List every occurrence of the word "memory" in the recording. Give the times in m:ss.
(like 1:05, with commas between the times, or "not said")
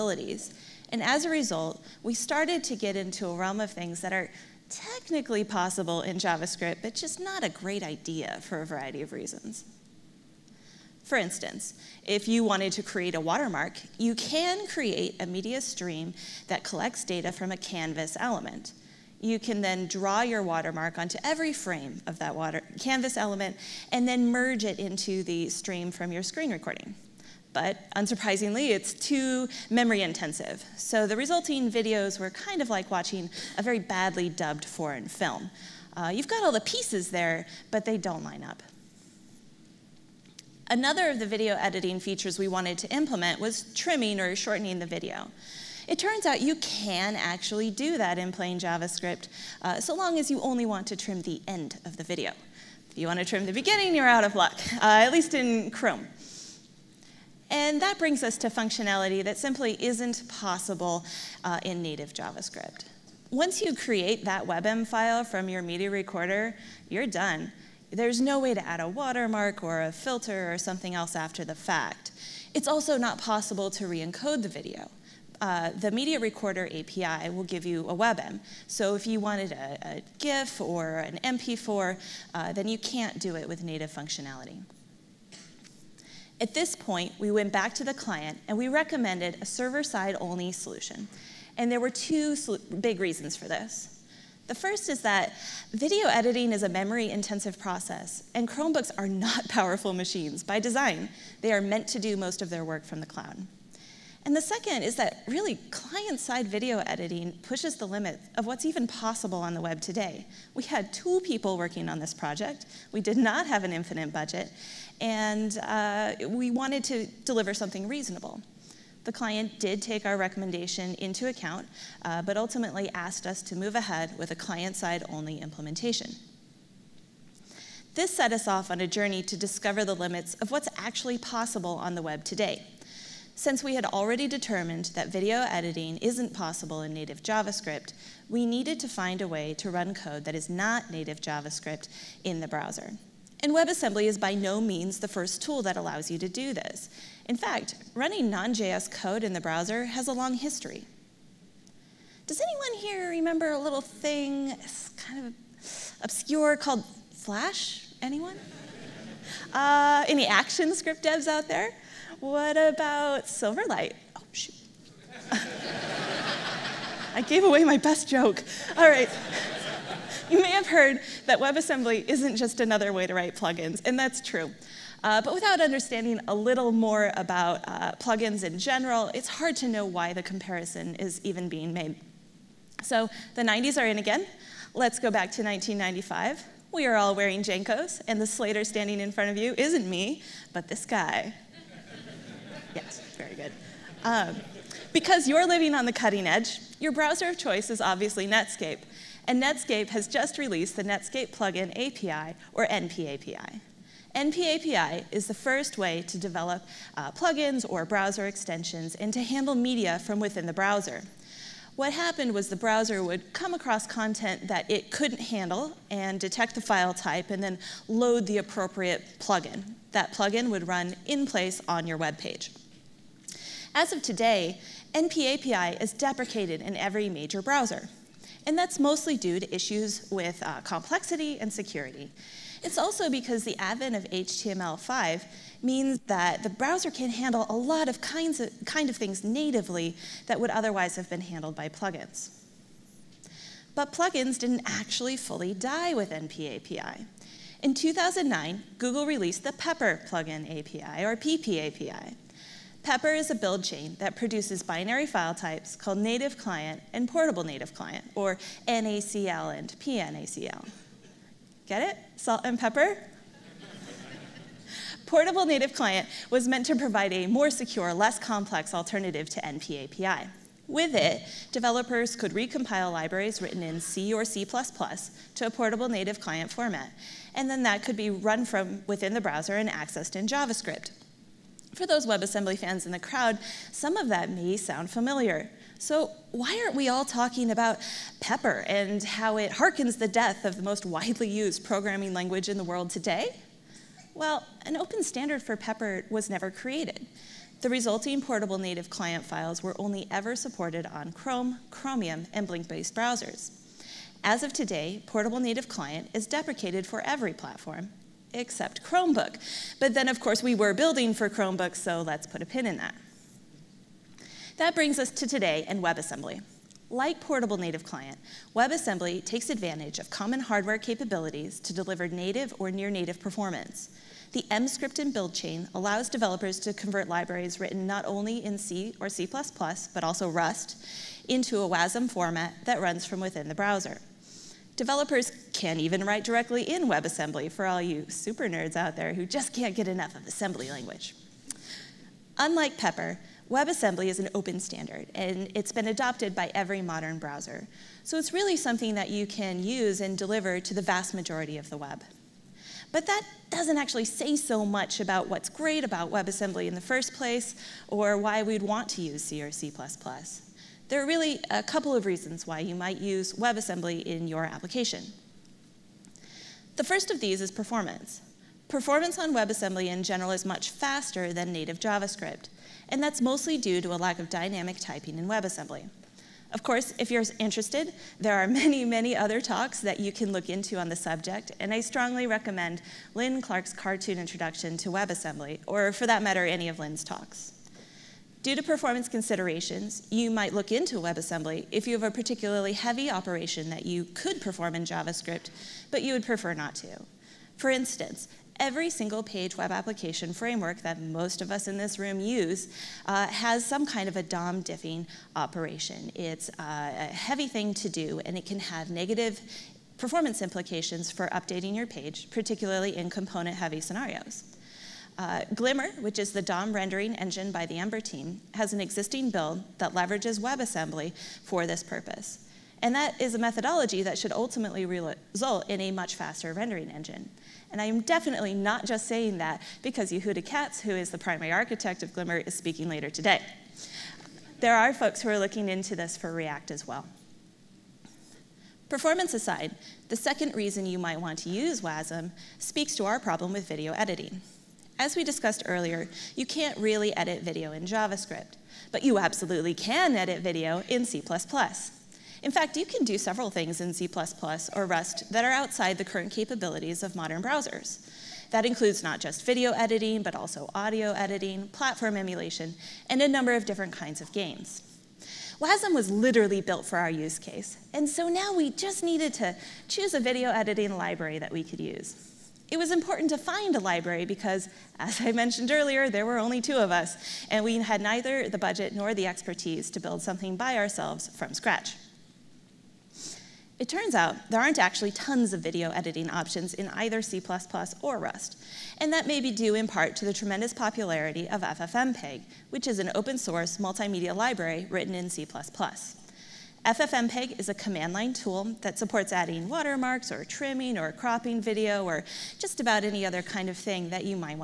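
0:29, 1:36.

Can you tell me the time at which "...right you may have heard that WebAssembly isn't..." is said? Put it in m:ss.
2:48.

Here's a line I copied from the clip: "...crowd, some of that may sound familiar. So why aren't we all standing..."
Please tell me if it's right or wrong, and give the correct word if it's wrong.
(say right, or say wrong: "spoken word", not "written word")
wrong: "talking", not "standing".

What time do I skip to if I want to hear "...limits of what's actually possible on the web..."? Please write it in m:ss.
2:09.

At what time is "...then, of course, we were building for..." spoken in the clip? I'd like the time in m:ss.
5:09.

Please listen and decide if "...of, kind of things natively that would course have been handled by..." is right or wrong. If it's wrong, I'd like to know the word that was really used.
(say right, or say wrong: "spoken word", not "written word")
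wrong: "otherwise", not "course".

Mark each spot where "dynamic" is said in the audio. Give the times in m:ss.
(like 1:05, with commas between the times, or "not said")
6:14.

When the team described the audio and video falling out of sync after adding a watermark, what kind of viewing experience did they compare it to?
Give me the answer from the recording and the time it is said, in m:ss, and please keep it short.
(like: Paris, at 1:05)
a very badly dubbed foreign film, at 0:33.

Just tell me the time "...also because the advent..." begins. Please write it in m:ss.
3:52.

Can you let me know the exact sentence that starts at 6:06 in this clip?
The first of these is performance.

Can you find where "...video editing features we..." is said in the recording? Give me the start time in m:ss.
0:41.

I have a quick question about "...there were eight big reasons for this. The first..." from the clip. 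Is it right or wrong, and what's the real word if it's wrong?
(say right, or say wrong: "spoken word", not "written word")
wrong: "two", not "eight".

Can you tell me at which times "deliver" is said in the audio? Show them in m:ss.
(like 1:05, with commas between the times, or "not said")
1:57, 5:21, 5:50.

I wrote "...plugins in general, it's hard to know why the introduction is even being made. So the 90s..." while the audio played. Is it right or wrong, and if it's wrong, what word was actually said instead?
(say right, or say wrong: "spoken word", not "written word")
wrong: "comparison", not "introduction".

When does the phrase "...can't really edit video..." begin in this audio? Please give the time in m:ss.
7:26.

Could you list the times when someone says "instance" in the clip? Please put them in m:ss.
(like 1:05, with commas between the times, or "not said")
0:11, 6:37.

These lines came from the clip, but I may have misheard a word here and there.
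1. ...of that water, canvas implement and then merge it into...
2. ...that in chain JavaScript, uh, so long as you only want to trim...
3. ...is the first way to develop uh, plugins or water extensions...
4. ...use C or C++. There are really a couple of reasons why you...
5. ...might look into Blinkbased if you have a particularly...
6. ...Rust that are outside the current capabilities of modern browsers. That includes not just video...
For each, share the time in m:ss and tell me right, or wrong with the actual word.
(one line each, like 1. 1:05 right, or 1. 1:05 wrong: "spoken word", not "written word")
1. 0:22 wrong: "element", not "implement"
2. 0:47 wrong: "plain", not "chain"
3. 3:25 wrong: "browser", not "water"
4. 5:59 right
5. 6:30 wrong: "WebAssembly", not "Blinkbased"
6. 7:34 right.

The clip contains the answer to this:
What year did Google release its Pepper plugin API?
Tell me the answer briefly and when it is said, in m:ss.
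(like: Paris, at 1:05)
2009, at 4:07.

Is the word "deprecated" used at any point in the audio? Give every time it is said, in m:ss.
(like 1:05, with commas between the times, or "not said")
3:45, 5:06.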